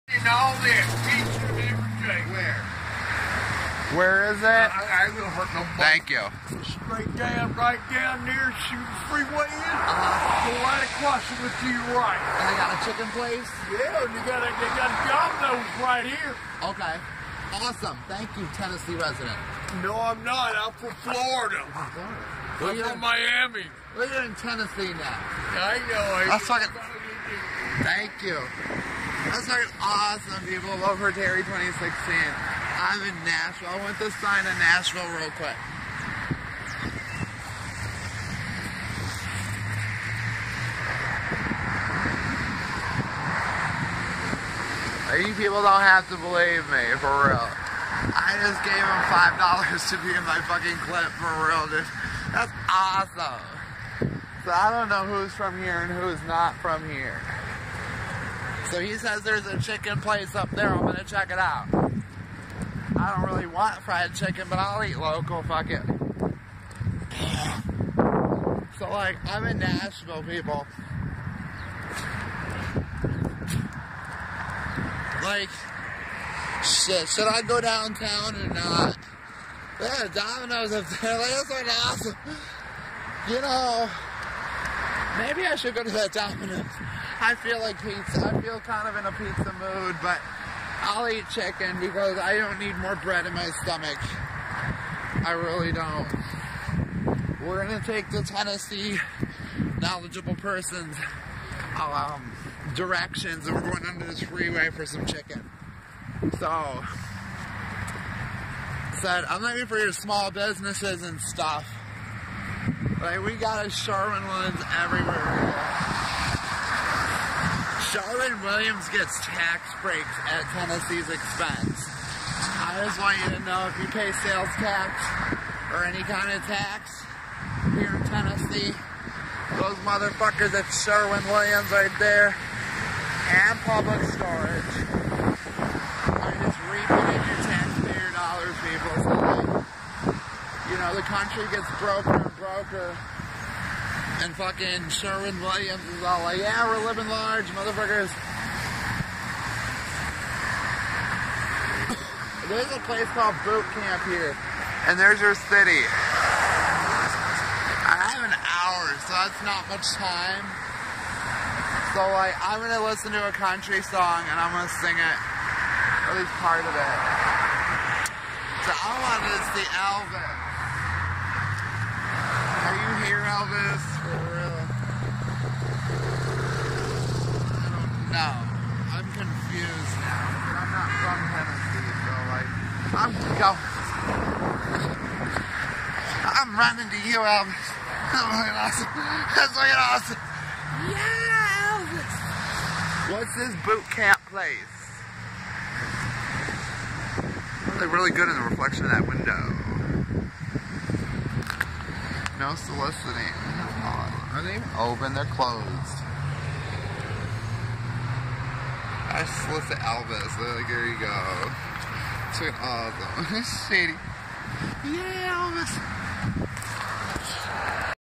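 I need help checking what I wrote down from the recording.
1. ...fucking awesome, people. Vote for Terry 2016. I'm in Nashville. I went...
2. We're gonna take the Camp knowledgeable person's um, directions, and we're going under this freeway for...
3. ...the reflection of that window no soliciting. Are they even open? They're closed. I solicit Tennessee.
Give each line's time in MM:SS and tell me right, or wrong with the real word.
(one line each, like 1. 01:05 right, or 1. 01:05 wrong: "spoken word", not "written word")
1. 00:29 right
2. 01:37 wrong: "Tennessee", not "Camp"
3. 03:18 wrong: "Elvis", not "Tennessee".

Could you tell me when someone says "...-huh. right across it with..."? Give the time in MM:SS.
00:09.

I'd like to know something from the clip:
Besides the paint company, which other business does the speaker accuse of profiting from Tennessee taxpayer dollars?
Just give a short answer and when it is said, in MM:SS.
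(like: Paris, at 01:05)
Public Storage, at 02:13.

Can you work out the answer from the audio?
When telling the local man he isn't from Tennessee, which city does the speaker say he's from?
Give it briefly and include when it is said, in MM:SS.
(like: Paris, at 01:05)
Miami, at 00:23.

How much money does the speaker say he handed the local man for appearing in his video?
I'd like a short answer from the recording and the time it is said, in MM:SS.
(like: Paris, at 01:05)
$5, at 00:49.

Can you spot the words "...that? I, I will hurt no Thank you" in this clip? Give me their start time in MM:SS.
00:04.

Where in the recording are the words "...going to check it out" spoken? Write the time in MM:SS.
01:00.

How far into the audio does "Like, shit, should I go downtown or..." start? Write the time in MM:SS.
01:15.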